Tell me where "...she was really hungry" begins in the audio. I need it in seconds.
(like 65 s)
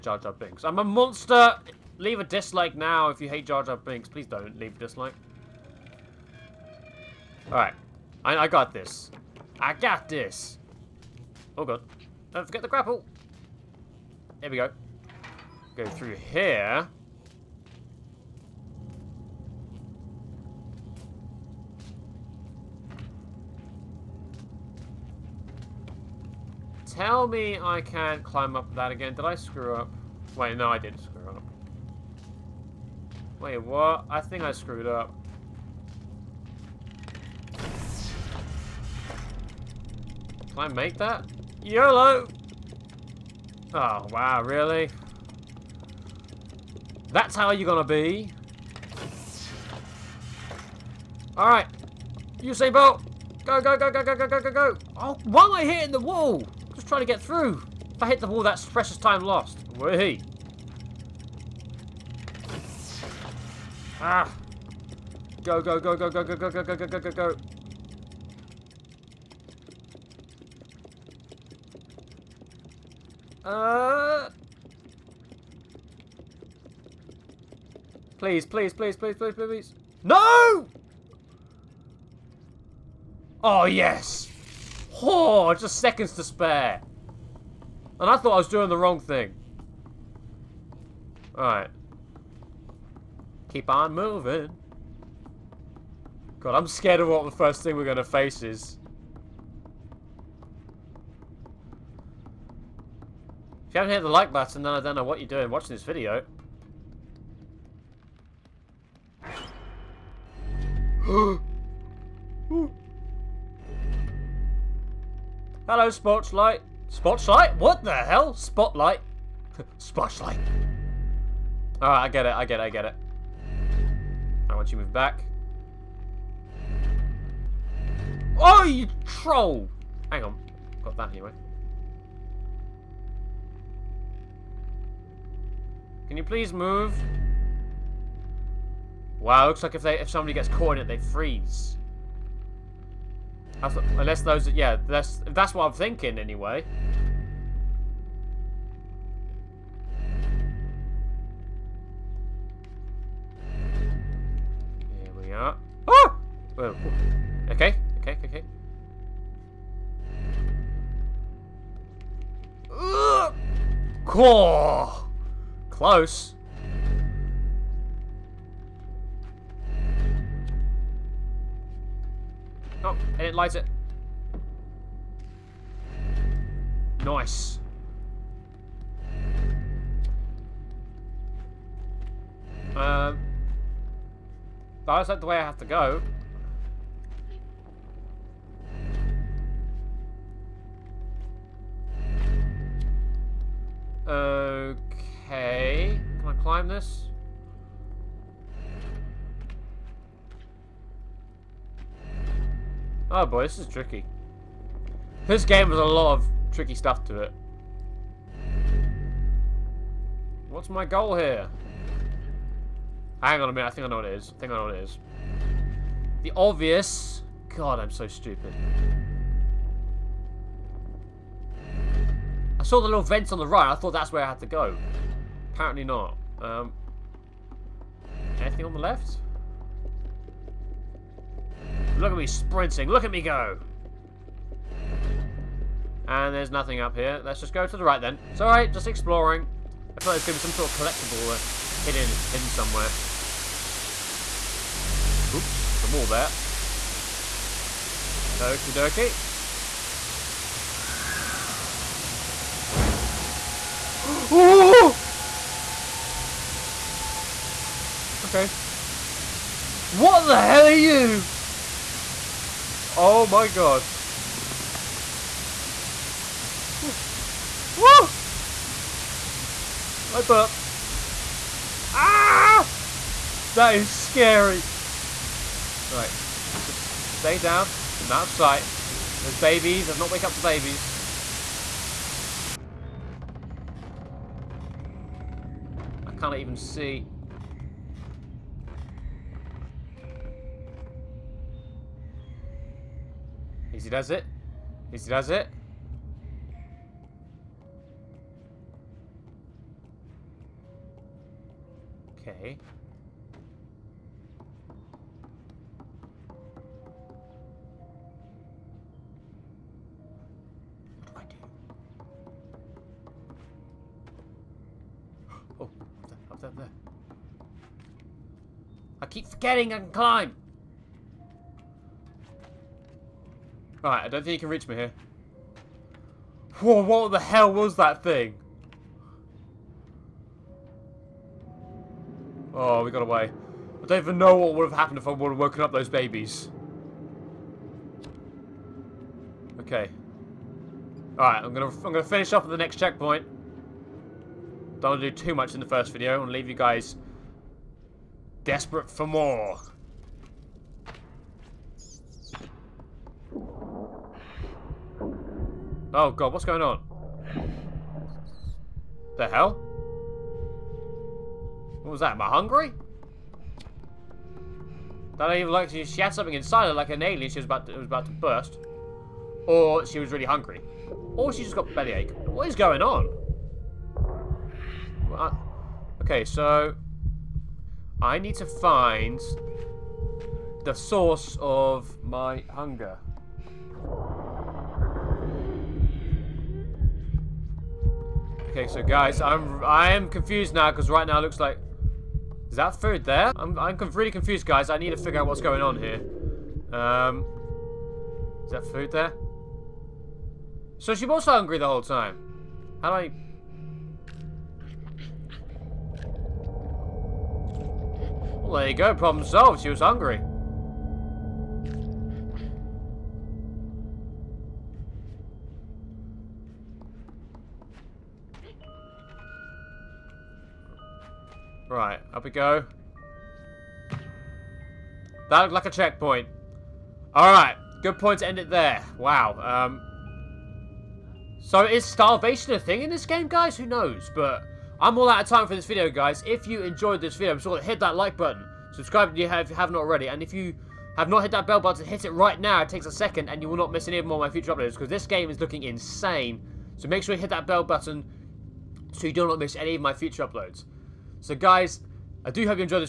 369 s.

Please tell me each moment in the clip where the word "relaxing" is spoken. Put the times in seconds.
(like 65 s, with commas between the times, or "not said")
not said.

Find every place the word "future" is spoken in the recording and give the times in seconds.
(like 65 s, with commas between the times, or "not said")
444 s, 449 s.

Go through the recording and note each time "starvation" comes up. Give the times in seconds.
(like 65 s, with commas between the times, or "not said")
431 s.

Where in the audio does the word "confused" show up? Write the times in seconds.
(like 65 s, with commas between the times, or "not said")
390 s, 394 s.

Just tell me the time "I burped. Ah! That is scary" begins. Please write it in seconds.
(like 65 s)
270 s.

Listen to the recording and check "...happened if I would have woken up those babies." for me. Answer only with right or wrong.
right.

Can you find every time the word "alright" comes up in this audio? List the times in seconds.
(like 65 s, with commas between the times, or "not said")
7 s, 51 s, 91 s, 121 s, 238 s, 323 s, 341 s, 427 s.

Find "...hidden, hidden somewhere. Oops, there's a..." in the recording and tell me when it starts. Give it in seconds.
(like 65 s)
241 s.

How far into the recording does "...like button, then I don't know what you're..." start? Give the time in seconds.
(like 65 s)
104 s.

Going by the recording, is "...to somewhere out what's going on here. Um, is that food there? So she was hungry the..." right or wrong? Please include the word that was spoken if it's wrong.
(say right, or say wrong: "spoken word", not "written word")
wrong: "figure", not "somewhere".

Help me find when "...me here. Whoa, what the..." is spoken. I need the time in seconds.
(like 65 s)
324 s.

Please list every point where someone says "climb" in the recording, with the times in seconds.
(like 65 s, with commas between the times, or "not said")
28 s, 196 s, 319 s.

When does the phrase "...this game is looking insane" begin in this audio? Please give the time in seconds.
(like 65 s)
444 s.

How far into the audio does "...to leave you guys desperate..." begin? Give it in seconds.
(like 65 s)
346 s.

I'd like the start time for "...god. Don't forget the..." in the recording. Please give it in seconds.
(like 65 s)
11 s.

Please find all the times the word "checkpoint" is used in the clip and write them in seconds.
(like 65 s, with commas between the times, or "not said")
342 s, 425 s.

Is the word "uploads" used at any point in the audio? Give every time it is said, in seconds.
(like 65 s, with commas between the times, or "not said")
444 s, 450 s.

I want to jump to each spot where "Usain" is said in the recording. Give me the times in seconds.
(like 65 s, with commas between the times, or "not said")
52 s.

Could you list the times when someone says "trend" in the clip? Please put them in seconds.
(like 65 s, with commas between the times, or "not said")
not said.